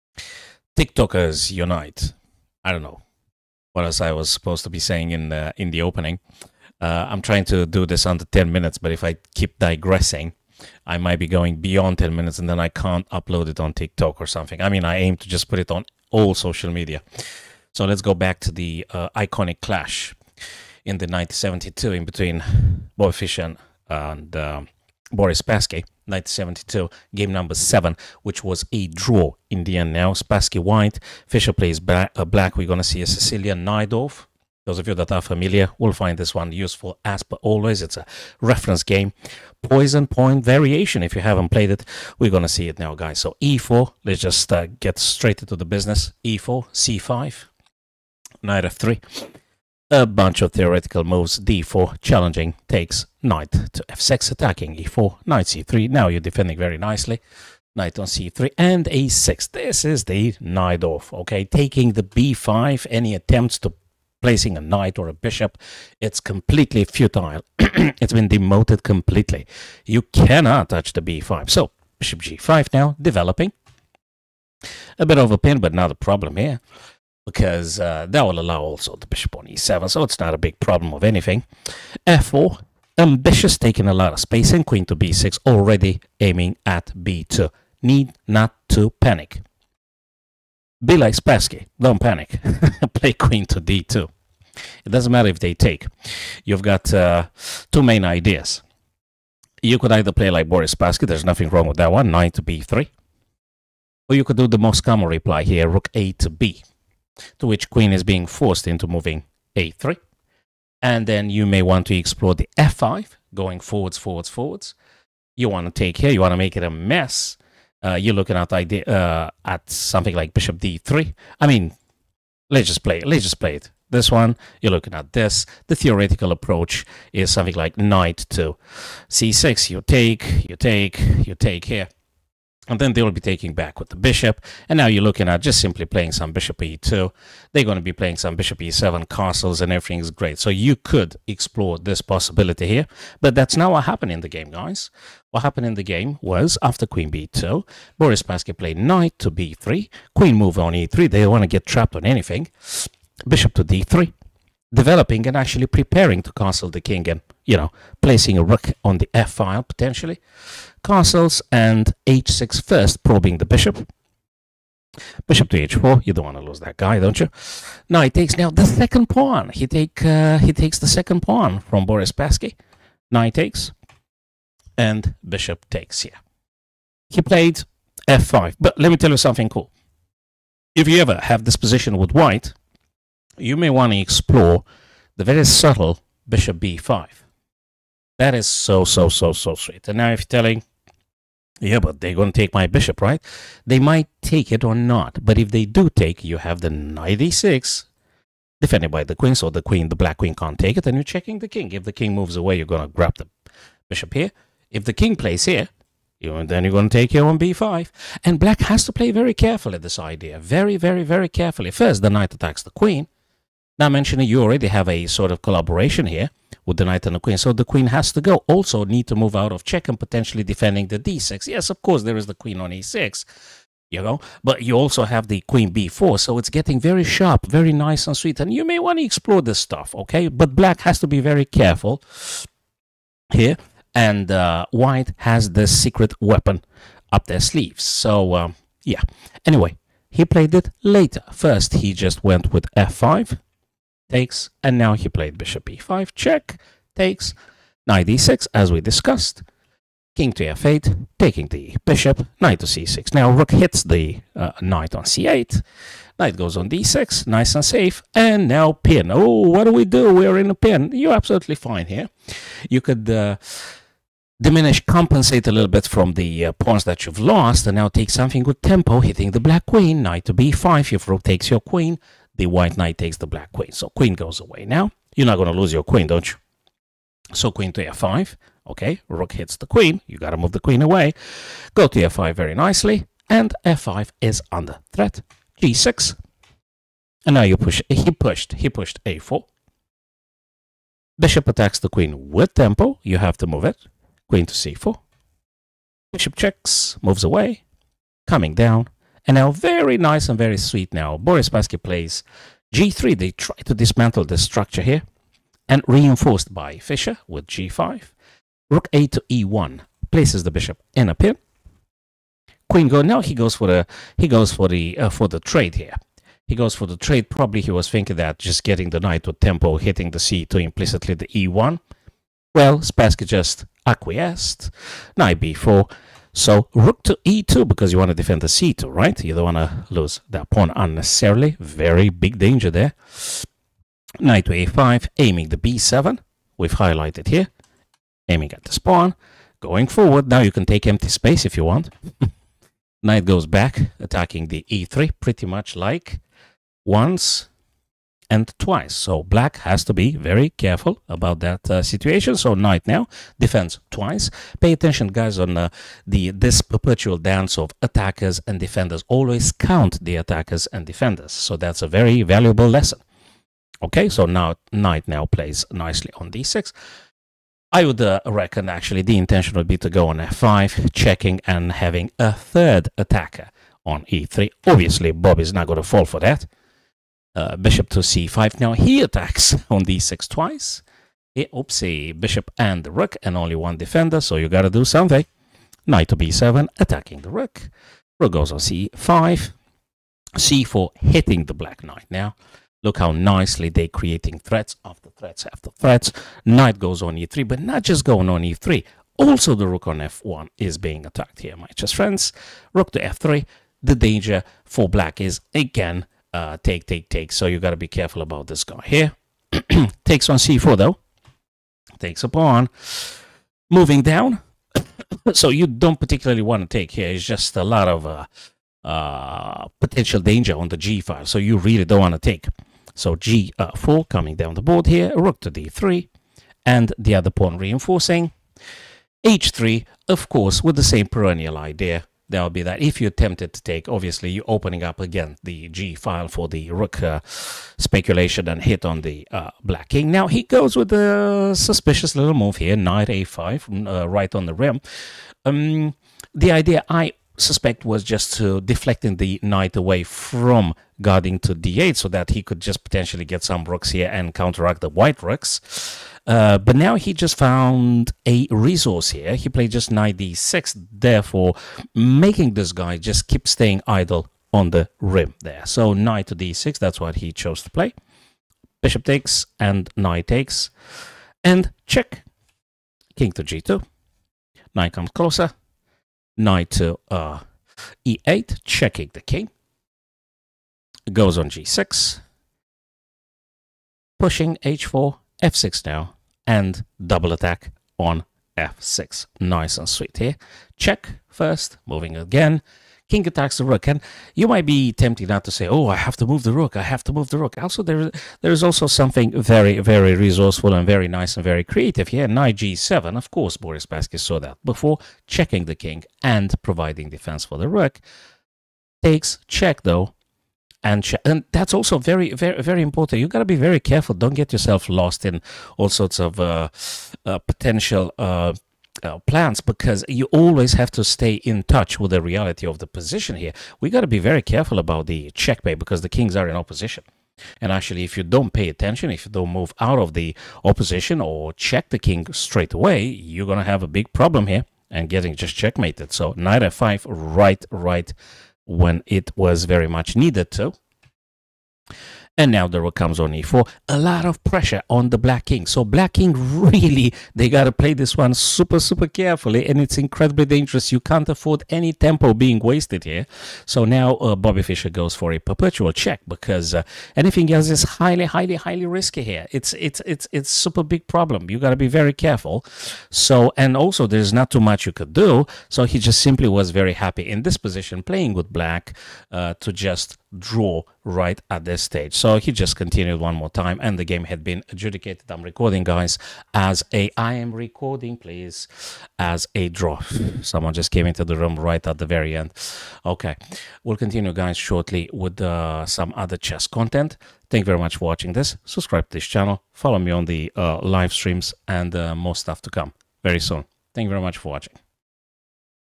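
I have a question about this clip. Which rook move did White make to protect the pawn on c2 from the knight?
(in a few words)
Rook to e2.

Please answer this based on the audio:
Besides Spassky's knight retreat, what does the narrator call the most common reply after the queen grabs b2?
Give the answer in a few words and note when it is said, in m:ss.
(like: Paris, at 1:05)
Rook a to b, at 1:45.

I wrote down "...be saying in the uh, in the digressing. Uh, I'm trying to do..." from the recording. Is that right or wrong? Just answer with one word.
wrong.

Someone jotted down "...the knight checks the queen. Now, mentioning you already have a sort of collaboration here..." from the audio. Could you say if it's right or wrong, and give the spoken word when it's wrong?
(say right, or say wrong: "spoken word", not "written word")
wrong: "attacks", not "checks".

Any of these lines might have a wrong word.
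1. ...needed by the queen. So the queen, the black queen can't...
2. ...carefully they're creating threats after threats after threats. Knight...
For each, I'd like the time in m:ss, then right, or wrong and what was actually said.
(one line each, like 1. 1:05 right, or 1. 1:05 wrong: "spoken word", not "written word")
1. 3:18 wrong: "defended", not "needed"
2. 6:33 wrong: "nicely", not "carefully".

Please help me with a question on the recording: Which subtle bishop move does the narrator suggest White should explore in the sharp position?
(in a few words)
Bishop b5.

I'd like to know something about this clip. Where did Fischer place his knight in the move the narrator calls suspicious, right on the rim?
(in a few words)
a5.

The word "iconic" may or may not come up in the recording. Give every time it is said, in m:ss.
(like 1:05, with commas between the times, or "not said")
0:19.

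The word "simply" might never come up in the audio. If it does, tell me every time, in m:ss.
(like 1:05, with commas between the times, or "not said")
2:15, 9:26.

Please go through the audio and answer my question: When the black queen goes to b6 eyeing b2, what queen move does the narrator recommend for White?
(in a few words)
Queen to d2.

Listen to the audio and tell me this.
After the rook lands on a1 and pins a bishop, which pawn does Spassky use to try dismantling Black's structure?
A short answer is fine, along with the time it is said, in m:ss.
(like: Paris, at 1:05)
g3, at 5:02.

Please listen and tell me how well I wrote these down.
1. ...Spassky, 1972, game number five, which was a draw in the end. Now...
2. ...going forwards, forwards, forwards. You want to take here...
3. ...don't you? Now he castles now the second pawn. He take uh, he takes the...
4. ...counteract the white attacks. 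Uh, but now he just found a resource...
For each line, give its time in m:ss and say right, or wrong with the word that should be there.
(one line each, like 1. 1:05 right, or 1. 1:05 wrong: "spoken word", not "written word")
1. 0:25 wrong: "seven", not "five"
2. 1:53 right
3. 2:46 wrong: "takes", not "castles"
4. 7:34 wrong: "rooks", not "attacks".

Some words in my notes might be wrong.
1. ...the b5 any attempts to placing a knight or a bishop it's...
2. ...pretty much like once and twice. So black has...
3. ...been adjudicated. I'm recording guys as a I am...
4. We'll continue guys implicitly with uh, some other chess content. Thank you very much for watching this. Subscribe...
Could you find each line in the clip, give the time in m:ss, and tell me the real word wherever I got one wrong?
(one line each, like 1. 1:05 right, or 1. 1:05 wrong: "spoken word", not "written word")
1. 1:01 right
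2. 5:45 right
3. 9:34 right
4. 9:43 wrong: "shortly", not "implicitly".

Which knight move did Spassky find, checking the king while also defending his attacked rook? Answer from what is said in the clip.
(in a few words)
Knight g7.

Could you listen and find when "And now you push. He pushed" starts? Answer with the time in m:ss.
4:47.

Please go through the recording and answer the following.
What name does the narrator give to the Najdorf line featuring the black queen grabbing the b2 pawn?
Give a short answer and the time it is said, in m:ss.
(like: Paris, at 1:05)
Poison pawn variation, at 0:39.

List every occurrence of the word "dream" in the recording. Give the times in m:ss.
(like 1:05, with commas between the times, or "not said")
not said.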